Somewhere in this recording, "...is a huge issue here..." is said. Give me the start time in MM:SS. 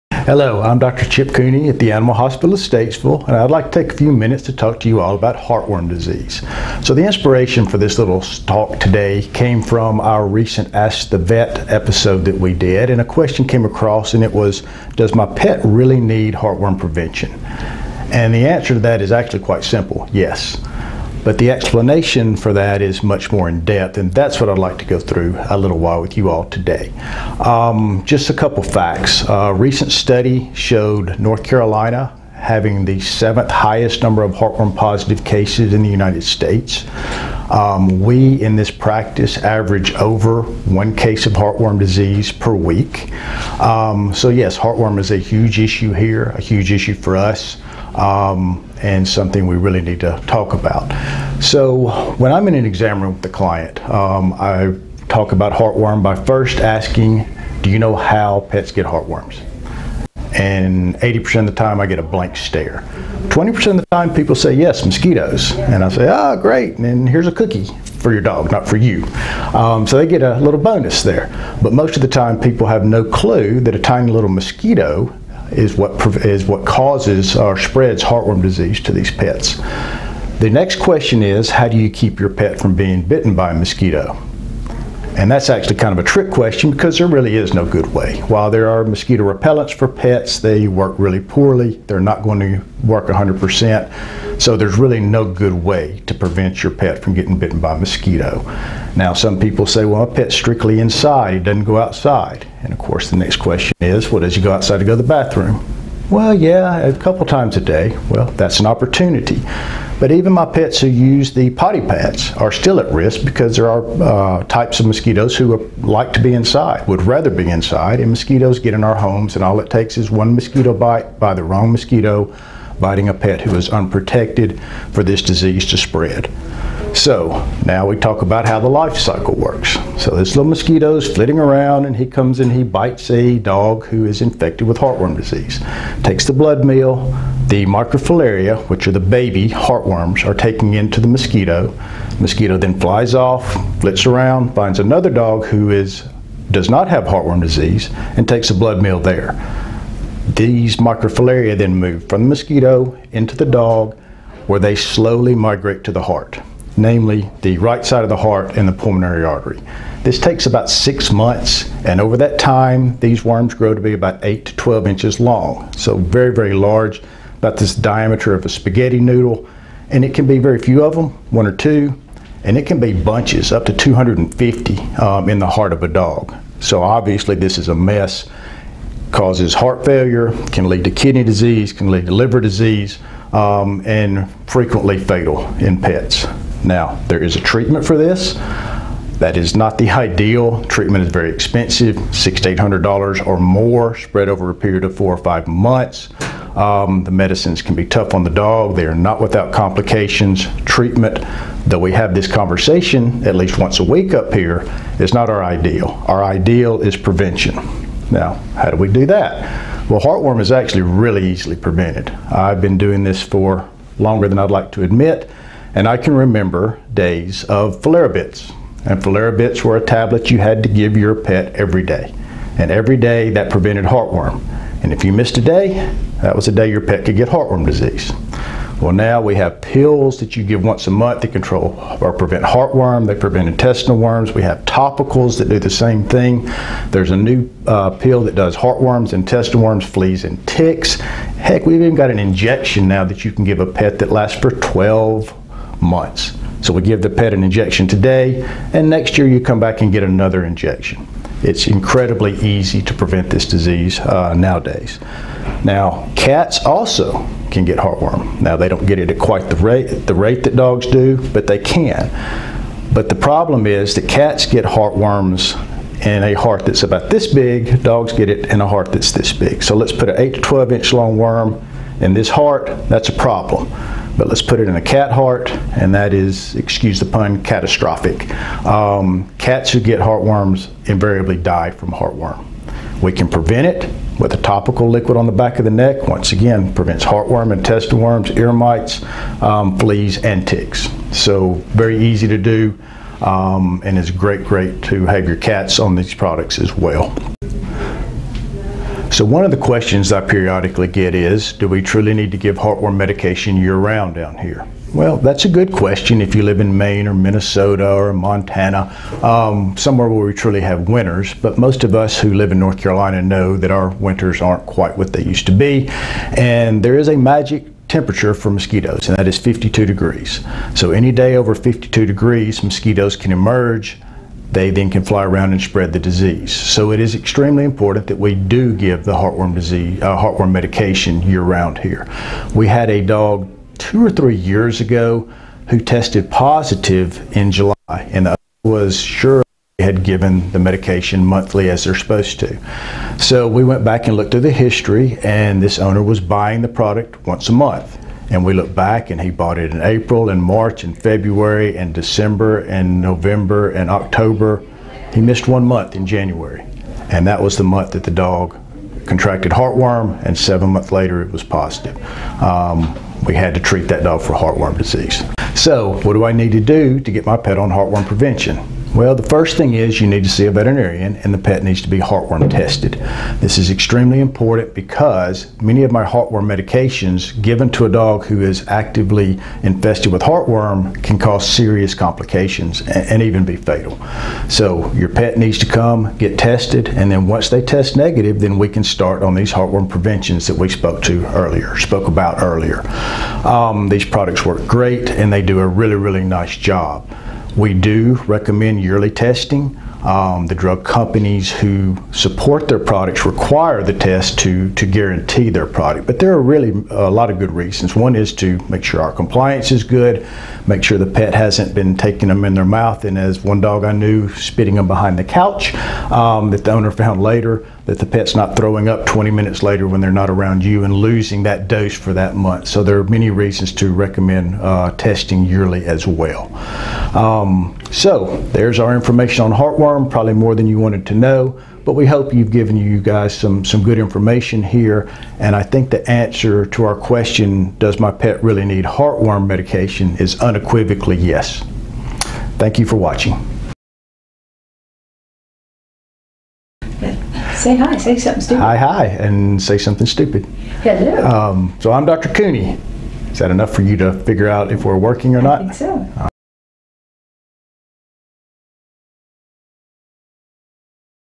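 00:44.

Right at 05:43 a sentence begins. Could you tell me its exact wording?
So we went back and looked at the history and this owner was buying the product once a month.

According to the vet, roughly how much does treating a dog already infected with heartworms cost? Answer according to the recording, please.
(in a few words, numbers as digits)
$600 to $800.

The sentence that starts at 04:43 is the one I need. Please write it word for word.
We can prevent it with a topical liquid on the back of the neck.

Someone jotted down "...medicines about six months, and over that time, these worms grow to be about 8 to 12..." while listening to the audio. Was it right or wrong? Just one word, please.
wrong.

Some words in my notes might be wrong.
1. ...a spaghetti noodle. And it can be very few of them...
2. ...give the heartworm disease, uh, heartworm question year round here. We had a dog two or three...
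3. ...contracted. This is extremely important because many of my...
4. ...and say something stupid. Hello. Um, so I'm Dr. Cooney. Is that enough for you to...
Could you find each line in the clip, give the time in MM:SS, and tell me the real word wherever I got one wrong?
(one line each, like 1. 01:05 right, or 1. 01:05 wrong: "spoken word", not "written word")
1. 02:48 right
2. 05:28 wrong: "medication", not "question"
3. 06:12 wrong: "tested", not "contracted"
4. 07:29 right.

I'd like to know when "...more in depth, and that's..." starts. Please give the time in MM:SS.
00:23.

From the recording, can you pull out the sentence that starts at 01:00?
And 80% of the time I get a blank stare.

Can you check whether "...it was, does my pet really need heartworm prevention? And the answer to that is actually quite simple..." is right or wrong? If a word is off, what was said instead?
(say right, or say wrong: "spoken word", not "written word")
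right.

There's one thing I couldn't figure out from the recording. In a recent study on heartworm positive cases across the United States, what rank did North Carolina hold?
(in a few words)
7th.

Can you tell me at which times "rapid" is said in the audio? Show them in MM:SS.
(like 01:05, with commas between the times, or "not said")
not said.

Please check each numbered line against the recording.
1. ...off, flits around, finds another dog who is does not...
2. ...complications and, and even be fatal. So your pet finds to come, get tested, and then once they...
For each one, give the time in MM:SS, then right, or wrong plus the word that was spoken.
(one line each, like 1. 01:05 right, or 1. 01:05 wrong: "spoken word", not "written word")
1. 02:23 right
2. 06:21 wrong: "needs", not "finds".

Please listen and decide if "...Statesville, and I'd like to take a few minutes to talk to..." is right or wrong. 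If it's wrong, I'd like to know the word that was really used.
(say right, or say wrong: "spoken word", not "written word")
right.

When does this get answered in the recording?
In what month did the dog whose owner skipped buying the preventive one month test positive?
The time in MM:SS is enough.
05:37.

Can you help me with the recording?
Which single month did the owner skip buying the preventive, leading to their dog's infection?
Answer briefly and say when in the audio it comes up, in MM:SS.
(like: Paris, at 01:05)
January, at 05:56.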